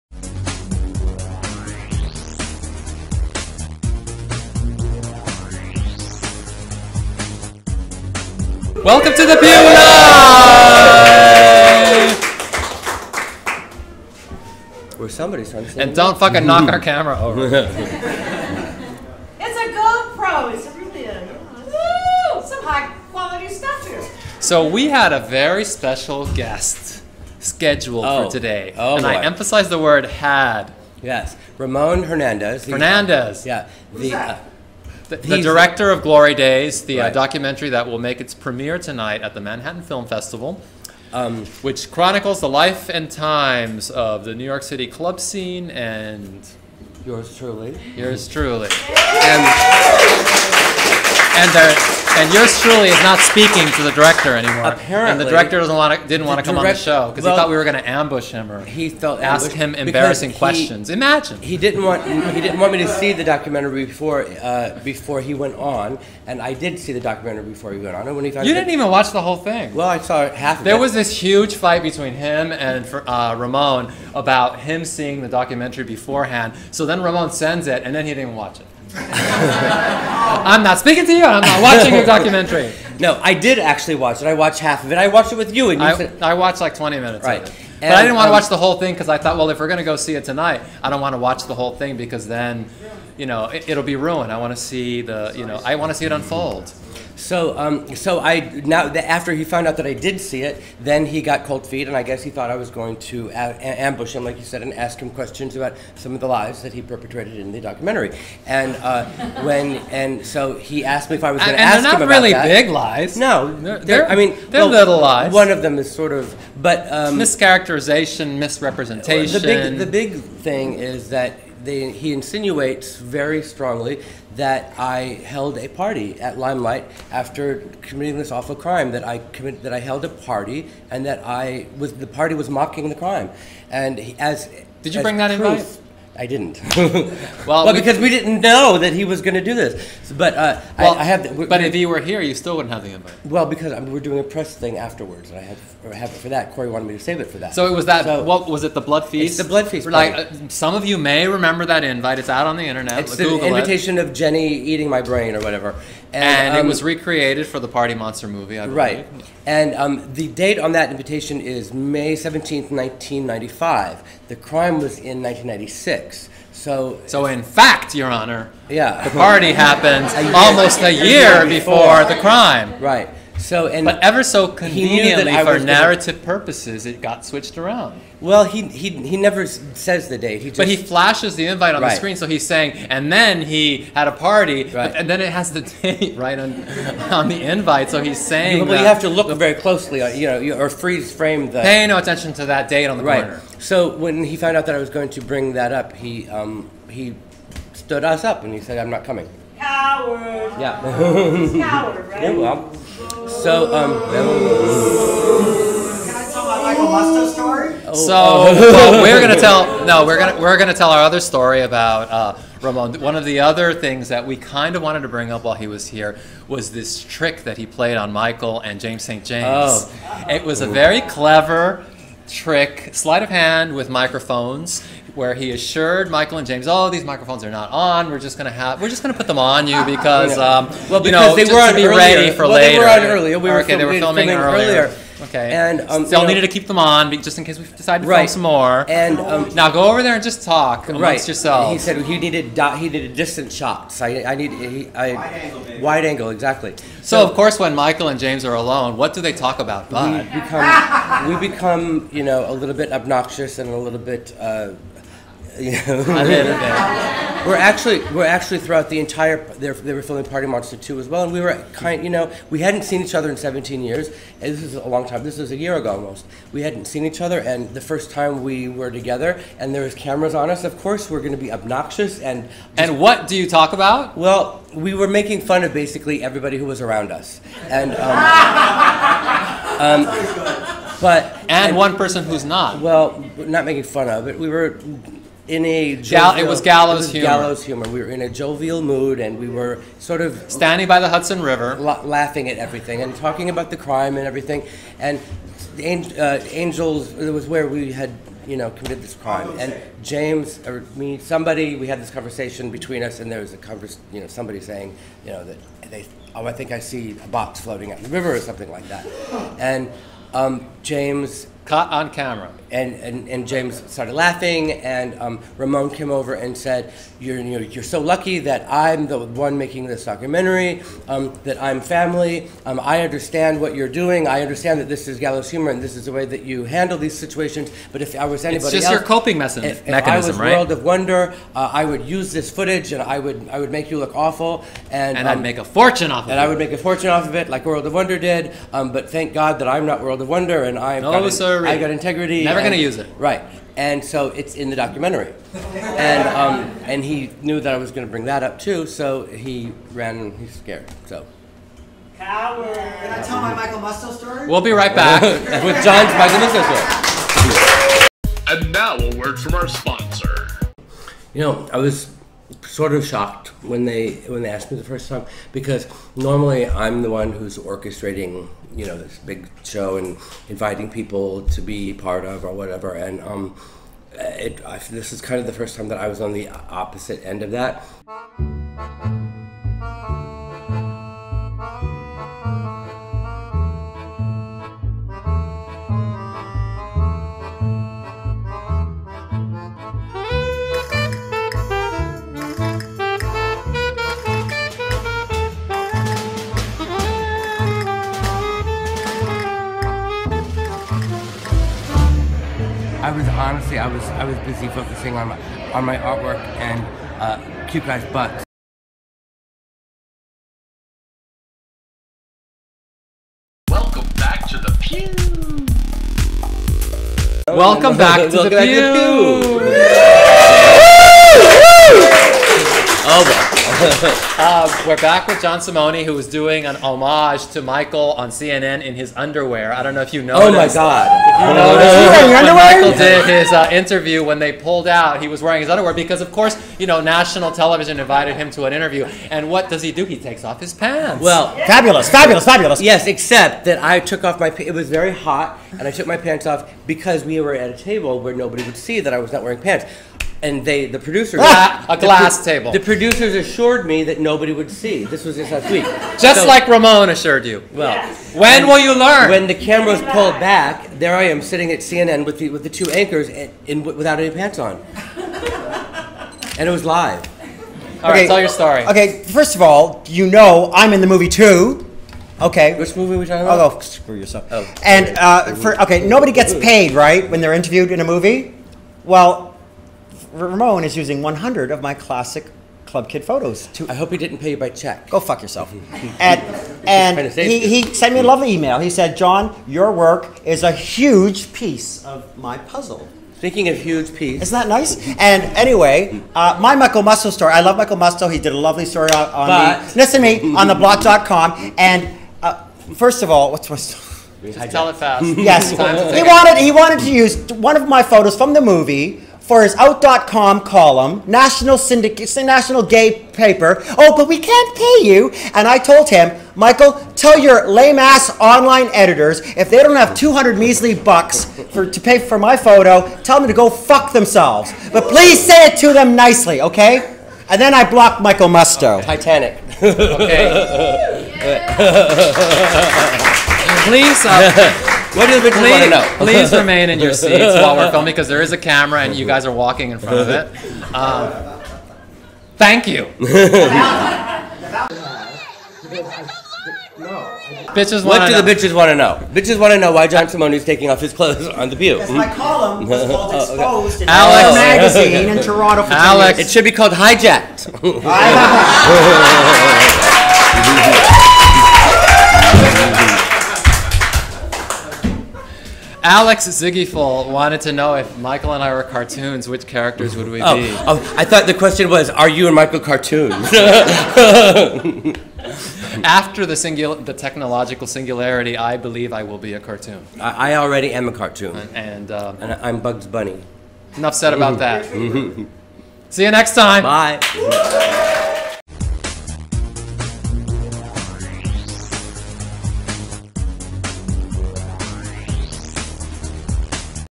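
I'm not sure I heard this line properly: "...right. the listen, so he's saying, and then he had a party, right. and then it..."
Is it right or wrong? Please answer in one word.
wrong.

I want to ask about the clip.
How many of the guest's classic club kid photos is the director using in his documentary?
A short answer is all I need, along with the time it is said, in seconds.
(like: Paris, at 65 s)
100, at 481 s.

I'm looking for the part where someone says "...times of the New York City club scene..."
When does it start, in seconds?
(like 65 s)
43 s.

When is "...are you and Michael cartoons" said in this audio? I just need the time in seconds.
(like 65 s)
572 s.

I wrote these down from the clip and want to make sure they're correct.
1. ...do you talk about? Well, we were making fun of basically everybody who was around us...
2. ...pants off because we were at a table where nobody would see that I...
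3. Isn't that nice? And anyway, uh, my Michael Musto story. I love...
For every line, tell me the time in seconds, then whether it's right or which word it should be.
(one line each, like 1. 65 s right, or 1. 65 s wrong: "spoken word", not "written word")
1. 273 s right
2. 446 s right
3. 494 s right.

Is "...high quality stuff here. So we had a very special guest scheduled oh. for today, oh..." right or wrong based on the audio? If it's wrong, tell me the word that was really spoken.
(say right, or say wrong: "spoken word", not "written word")
right.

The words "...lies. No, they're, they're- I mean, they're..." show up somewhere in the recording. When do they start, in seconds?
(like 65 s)
112 s.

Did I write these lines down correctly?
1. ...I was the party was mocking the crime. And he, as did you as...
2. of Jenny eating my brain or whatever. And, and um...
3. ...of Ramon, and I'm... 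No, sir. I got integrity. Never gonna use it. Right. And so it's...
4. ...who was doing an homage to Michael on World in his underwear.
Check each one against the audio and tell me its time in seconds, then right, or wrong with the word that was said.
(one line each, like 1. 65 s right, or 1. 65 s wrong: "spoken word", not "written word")
1. 131 s right
2. 154 s right
3. 340 s wrong: "Wonder", not "Ramon"
4. 426 s wrong: "CNN", not "World".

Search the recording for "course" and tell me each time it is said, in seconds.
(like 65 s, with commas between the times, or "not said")
247 s, 270 s, 436 s.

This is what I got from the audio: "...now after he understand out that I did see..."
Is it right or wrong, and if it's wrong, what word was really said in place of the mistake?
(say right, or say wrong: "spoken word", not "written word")
wrong: "found", not "understand".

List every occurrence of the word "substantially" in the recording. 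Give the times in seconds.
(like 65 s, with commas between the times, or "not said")
not said.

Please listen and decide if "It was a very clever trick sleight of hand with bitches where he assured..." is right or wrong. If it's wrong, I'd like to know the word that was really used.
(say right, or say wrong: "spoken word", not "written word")
wrong: "microphones", not "bitches".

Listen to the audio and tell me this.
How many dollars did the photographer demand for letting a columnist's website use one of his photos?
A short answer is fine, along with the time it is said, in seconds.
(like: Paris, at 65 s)
200, at 520 s.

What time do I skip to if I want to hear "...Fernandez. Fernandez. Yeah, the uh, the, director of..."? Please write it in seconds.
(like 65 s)
32 s.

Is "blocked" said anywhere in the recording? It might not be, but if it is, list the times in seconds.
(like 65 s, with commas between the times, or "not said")
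527 s.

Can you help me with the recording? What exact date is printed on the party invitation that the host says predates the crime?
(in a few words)
May 17th, 1995.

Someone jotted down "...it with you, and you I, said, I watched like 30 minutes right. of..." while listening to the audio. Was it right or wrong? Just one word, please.
wrong.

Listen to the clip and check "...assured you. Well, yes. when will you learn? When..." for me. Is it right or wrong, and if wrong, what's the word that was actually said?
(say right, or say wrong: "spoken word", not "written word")
right.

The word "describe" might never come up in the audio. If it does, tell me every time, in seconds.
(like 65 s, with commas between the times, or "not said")
not said.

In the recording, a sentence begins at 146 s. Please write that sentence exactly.
Corey wanted me to save it for that.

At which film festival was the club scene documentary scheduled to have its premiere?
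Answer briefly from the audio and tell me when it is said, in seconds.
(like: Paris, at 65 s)
Manhattan Film Festival, at 39 s.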